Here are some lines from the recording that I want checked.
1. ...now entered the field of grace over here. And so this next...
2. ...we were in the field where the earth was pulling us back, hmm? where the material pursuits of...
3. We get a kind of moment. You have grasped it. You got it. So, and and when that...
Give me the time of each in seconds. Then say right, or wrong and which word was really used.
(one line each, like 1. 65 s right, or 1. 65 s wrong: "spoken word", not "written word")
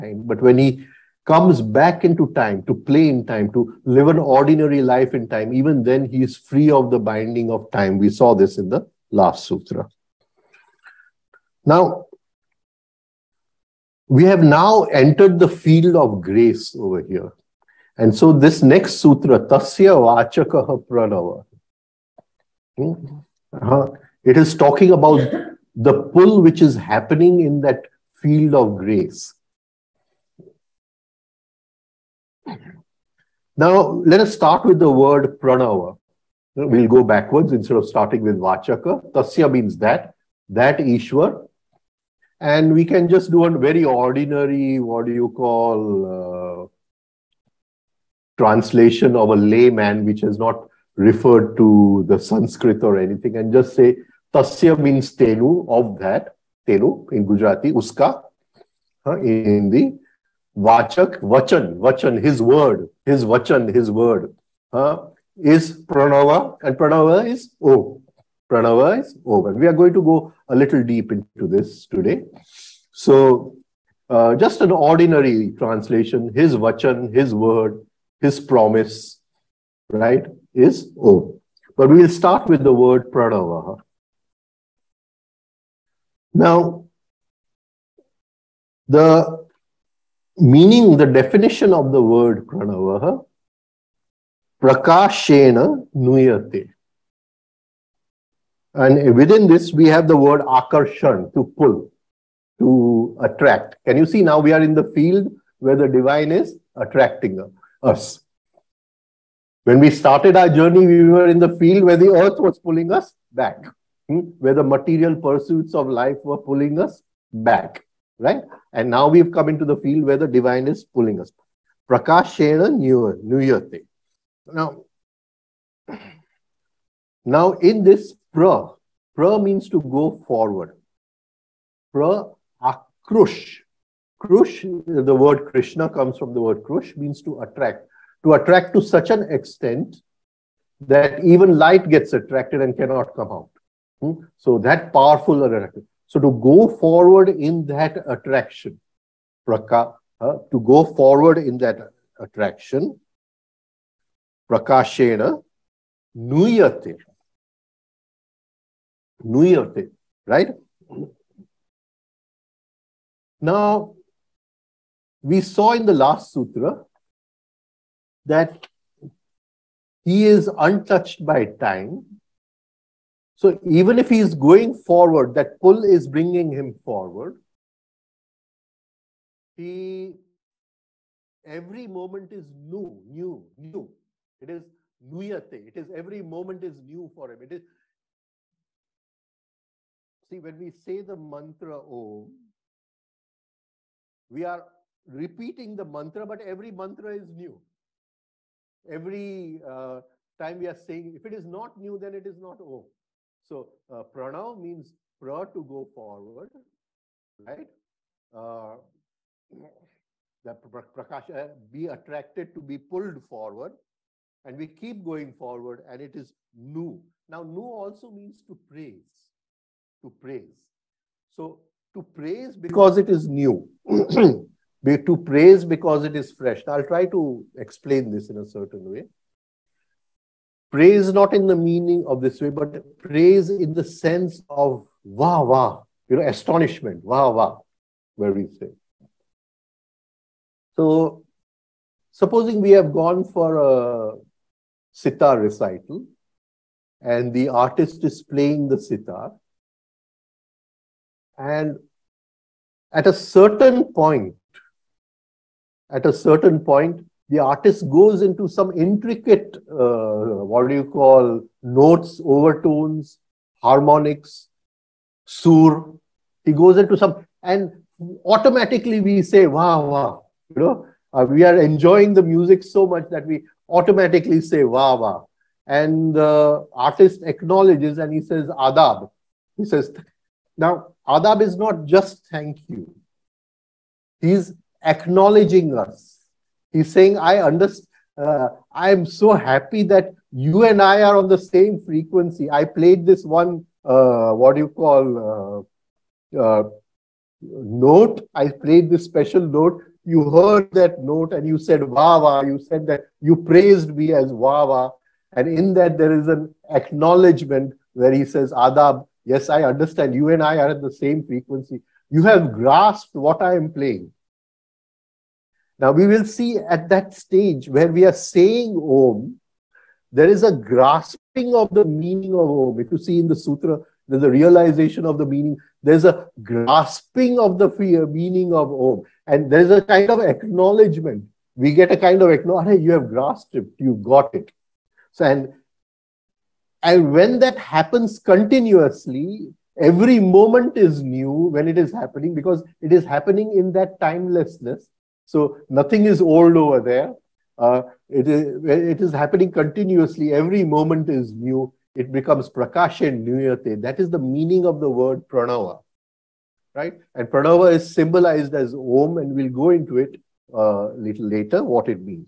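1. 14 s right
2. 110 s right
3. 331 s wrong: "acknowledgement", not "moment".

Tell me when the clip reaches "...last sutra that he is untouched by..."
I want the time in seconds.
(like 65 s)
165 s.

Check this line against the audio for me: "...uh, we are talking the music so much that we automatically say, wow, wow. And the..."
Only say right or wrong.
wrong.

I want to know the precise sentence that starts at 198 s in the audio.
Every uh, time we are saying, if it is not new, then it is not Om.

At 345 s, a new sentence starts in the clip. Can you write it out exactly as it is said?
So nothing is old over there.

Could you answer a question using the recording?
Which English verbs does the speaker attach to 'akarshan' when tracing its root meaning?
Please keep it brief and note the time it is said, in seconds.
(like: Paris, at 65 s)
to pull, to attract, at 101 s.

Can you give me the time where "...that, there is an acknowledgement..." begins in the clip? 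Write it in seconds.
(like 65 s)
305 s.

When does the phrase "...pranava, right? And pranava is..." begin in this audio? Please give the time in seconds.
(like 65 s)
355 s.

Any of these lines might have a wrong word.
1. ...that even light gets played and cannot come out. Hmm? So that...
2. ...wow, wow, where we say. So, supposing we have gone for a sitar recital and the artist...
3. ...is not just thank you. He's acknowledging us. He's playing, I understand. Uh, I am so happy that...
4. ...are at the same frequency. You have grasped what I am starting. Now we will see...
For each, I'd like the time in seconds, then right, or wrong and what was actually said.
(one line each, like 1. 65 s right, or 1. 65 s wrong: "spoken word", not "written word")
1. 140 s wrong: "attracted", not "played"
2. 237 s right
3. 281 s wrong: "saying", not "playing"
4. 310 s wrong: "playing", not "starting".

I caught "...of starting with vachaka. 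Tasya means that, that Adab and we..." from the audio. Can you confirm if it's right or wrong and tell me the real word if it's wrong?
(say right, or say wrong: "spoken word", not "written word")
wrong: "Ishwar", not "Adab".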